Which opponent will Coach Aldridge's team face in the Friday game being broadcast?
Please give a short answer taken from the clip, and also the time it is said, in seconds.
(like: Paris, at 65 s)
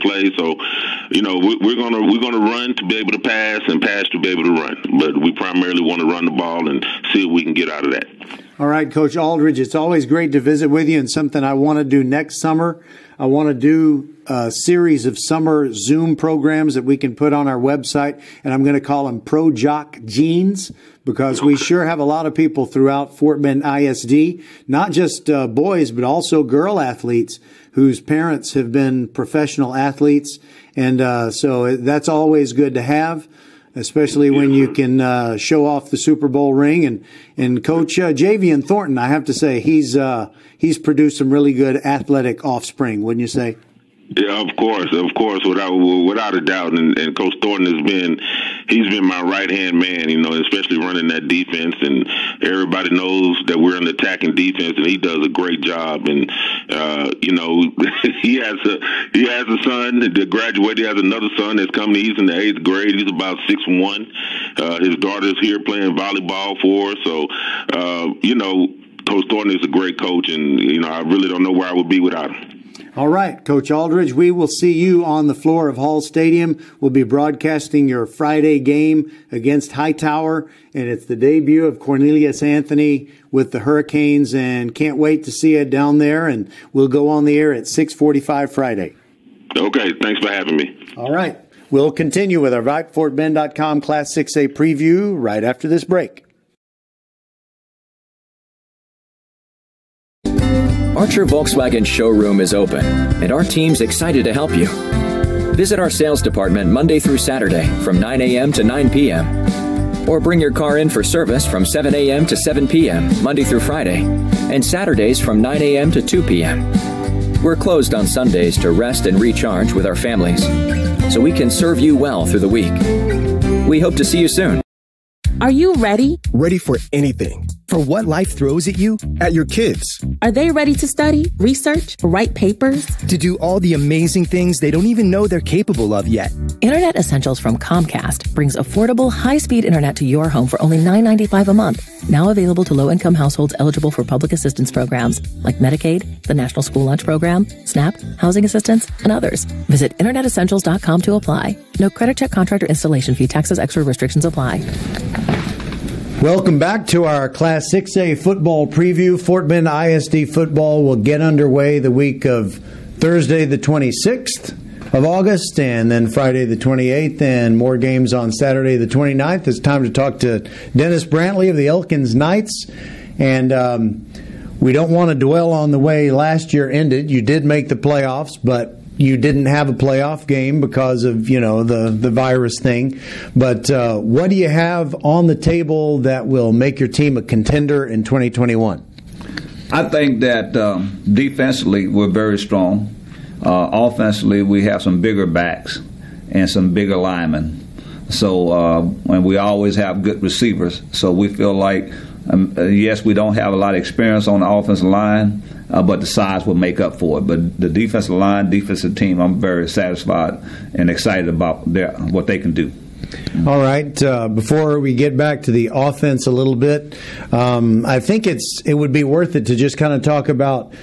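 Hightower, at 79 s.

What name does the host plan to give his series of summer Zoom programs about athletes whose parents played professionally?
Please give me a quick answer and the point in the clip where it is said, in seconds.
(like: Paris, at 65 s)
Pro Jock Jeans, at 19 s.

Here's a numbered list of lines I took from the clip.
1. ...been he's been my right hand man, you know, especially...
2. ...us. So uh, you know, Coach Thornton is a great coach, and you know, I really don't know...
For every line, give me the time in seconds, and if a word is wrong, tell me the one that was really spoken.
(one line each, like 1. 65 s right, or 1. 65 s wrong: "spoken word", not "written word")
1. 47 s right
2. 66 s right.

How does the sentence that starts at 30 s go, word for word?
And uh, so uh, that's always good to have especially when you can uh, show off the Super Bowl ring.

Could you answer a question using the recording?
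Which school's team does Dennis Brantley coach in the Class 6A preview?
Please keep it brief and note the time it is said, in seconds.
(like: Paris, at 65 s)
Elkins Knights, at 171 s.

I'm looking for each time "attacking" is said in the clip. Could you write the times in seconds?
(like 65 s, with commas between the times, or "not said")
53 s.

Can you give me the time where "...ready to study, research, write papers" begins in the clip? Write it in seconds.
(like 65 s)
130 s.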